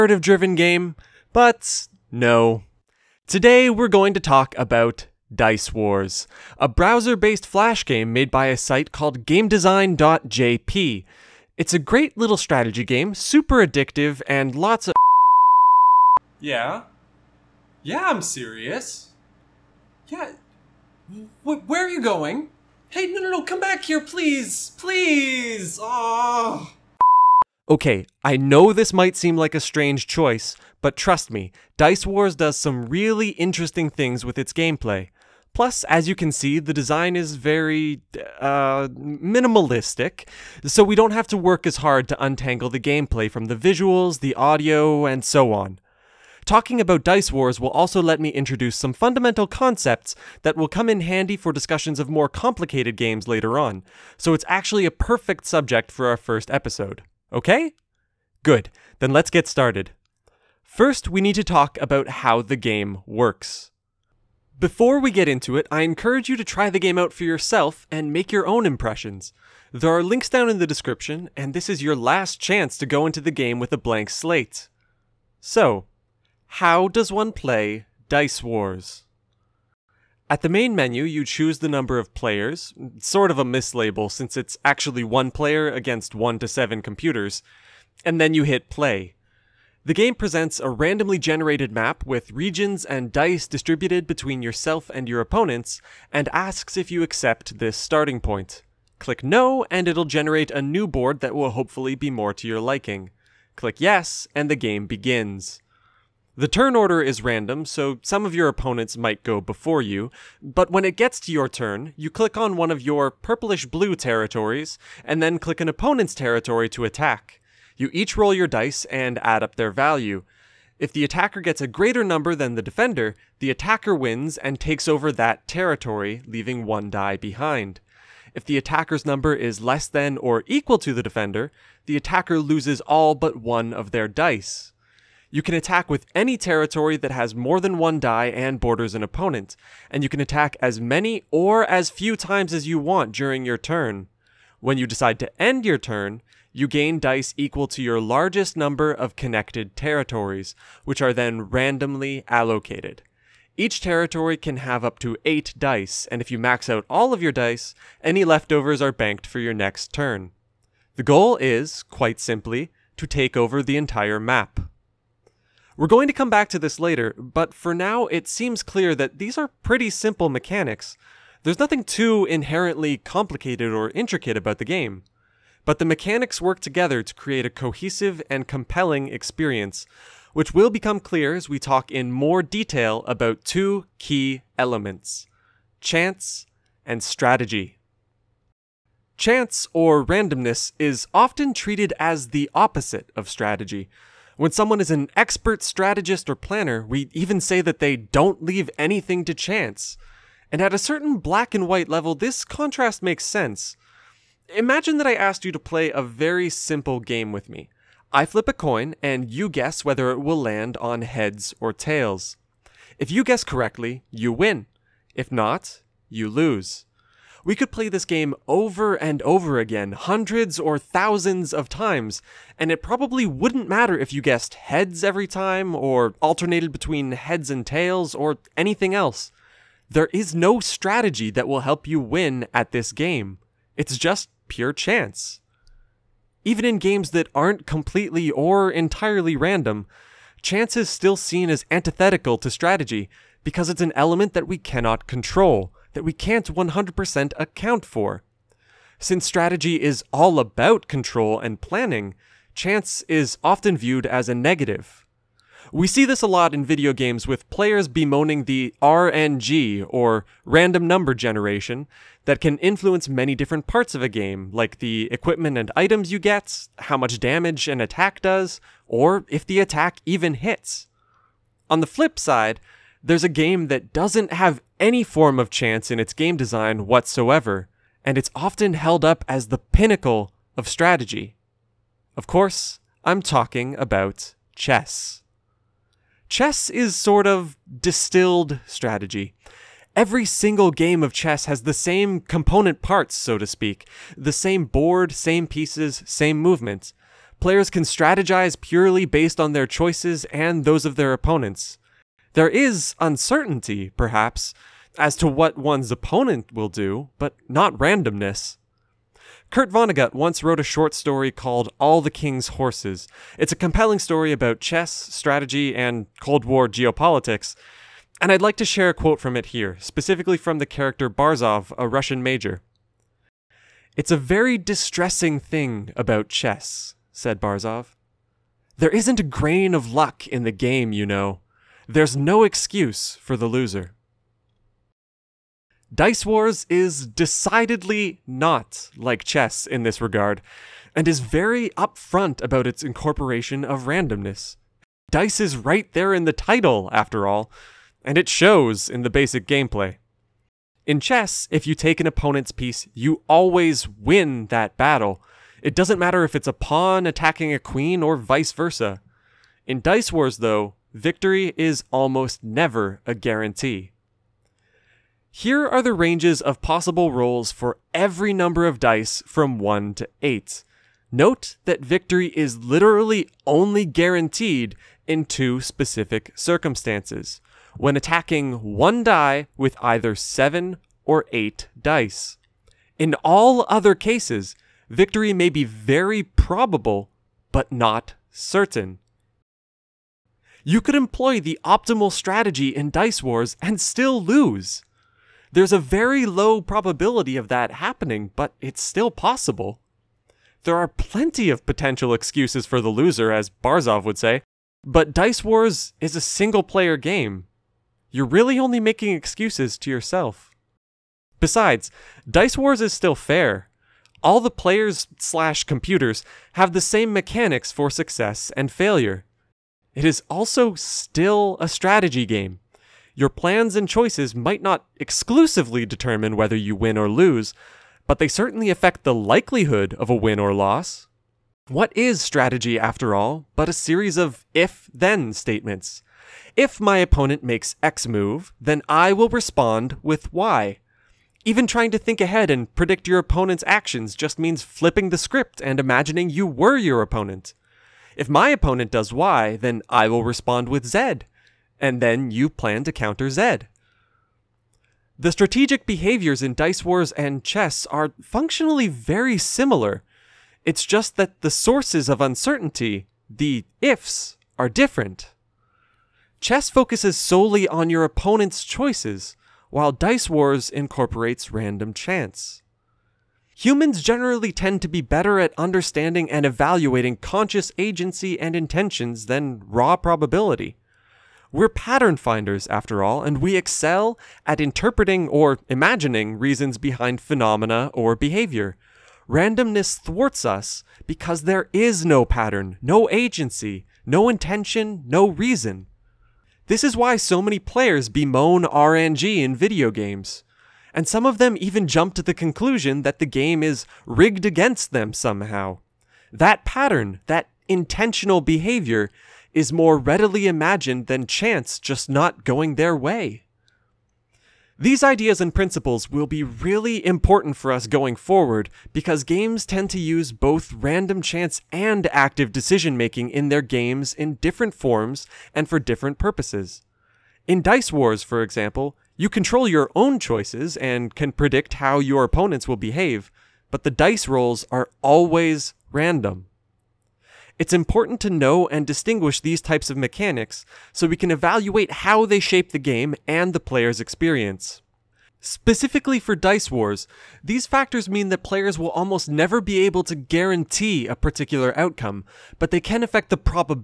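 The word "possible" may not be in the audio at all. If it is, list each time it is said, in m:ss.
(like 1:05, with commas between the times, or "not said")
6:06, 6:39.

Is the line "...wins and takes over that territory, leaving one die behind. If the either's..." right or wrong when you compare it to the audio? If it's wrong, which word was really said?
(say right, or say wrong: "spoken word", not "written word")
wrong: "attacker", not "either".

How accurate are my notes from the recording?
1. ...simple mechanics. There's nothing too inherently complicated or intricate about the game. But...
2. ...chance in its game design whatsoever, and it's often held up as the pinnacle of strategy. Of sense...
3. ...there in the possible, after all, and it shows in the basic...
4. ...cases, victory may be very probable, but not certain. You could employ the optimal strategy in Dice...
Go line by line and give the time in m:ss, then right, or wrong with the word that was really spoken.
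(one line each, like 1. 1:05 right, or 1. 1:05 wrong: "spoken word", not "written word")
1. 2:49 right
2. 4:35 wrong: "course", not "sense"
3. 5:45 wrong: "title", not "possible"
4. 6:23 right.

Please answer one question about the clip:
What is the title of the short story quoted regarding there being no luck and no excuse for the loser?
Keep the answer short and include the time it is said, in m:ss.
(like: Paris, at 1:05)
All the King's Horses, at 5:11.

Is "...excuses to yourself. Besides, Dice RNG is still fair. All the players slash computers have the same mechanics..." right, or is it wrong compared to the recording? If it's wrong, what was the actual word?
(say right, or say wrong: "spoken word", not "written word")
wrong: "Wars", not "RNG".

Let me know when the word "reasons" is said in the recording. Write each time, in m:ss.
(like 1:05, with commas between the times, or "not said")
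8:06, 8:15.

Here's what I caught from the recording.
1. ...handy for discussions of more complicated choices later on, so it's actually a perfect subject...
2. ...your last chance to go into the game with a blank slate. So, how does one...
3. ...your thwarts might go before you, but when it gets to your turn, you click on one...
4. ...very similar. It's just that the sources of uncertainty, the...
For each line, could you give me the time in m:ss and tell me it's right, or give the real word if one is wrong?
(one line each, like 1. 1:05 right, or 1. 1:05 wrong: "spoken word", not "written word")
1. 0:51 wrong: "games", not "choices"
2. 1:11 right
3. 1:48 wrong: "opponents", not "thwarts"
4. 7:38 right.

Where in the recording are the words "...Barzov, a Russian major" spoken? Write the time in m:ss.
5:21.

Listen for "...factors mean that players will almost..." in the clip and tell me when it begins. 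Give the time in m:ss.
9:07.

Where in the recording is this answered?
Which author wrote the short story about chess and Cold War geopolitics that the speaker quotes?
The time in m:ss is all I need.
5:09.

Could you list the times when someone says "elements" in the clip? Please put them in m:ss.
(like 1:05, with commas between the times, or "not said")
3:04, 4:03.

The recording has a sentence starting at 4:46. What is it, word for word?
Chess is sort of distilled strategy.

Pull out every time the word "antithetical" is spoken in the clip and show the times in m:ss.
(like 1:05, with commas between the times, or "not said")
4:01.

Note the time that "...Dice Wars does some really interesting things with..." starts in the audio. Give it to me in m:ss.
0:31.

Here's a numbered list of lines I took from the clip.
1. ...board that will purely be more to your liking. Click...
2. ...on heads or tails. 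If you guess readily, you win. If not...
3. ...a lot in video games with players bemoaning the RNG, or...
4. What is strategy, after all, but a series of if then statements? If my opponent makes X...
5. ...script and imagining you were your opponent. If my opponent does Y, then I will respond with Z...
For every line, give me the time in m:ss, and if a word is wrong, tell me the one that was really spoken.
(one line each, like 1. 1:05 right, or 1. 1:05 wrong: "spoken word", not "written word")
1. 1:40 wrong: "hopefully", not "purely"
2. 3:30 wrong: "correctly", not "readily"
3. 4:16 right
4. 7:11 right
5. 7:25 right.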